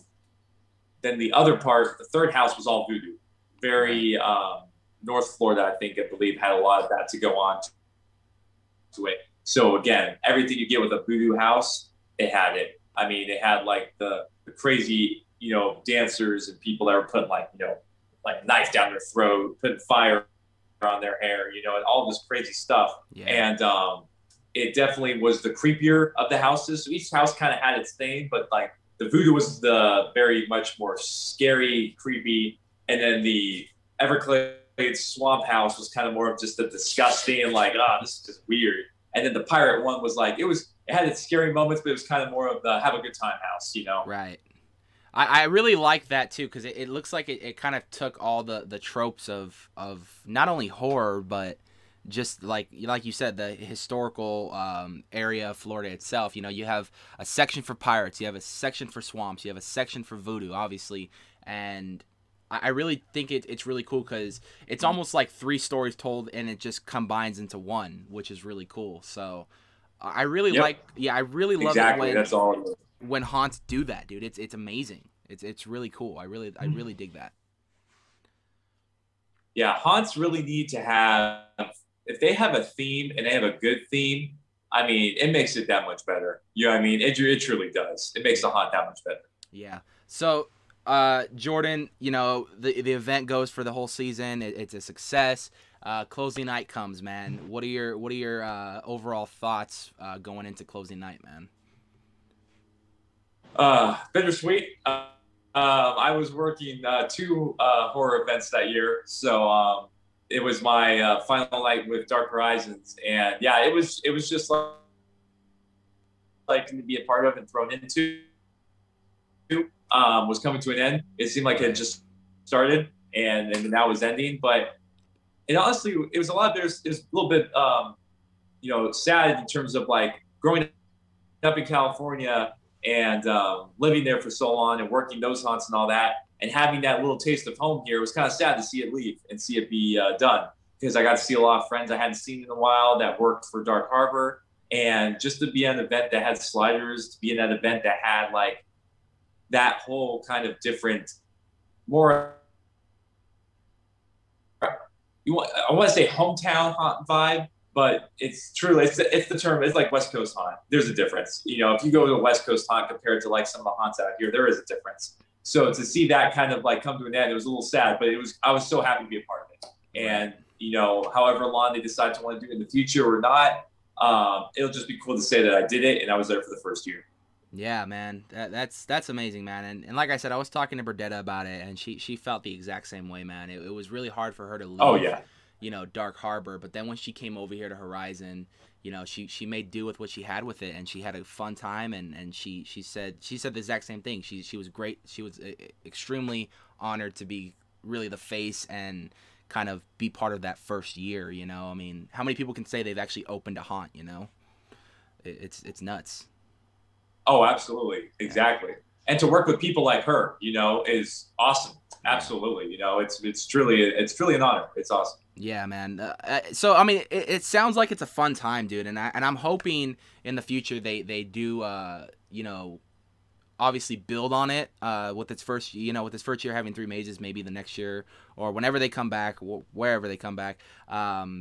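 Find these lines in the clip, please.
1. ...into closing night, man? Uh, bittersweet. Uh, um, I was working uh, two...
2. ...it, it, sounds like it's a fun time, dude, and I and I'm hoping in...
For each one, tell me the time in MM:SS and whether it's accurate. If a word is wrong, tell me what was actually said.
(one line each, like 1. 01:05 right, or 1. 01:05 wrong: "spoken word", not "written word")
1. 01:40 right
2. 03:37 right.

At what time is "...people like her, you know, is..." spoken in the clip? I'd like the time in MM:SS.
03:29.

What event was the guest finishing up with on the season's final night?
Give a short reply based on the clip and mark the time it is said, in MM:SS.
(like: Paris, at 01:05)
Dark Horizons, at 01:52.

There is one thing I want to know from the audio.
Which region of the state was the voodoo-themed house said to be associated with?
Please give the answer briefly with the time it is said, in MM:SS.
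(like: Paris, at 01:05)
North Florida, at 00:05.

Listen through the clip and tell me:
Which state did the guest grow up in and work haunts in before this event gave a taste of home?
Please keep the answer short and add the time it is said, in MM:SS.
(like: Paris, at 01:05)
California, at 02:11.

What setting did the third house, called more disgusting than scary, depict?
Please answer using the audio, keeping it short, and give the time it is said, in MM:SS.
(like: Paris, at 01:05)
Everglades swamp, at 00:34.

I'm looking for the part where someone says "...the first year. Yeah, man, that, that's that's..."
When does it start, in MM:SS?
02:56.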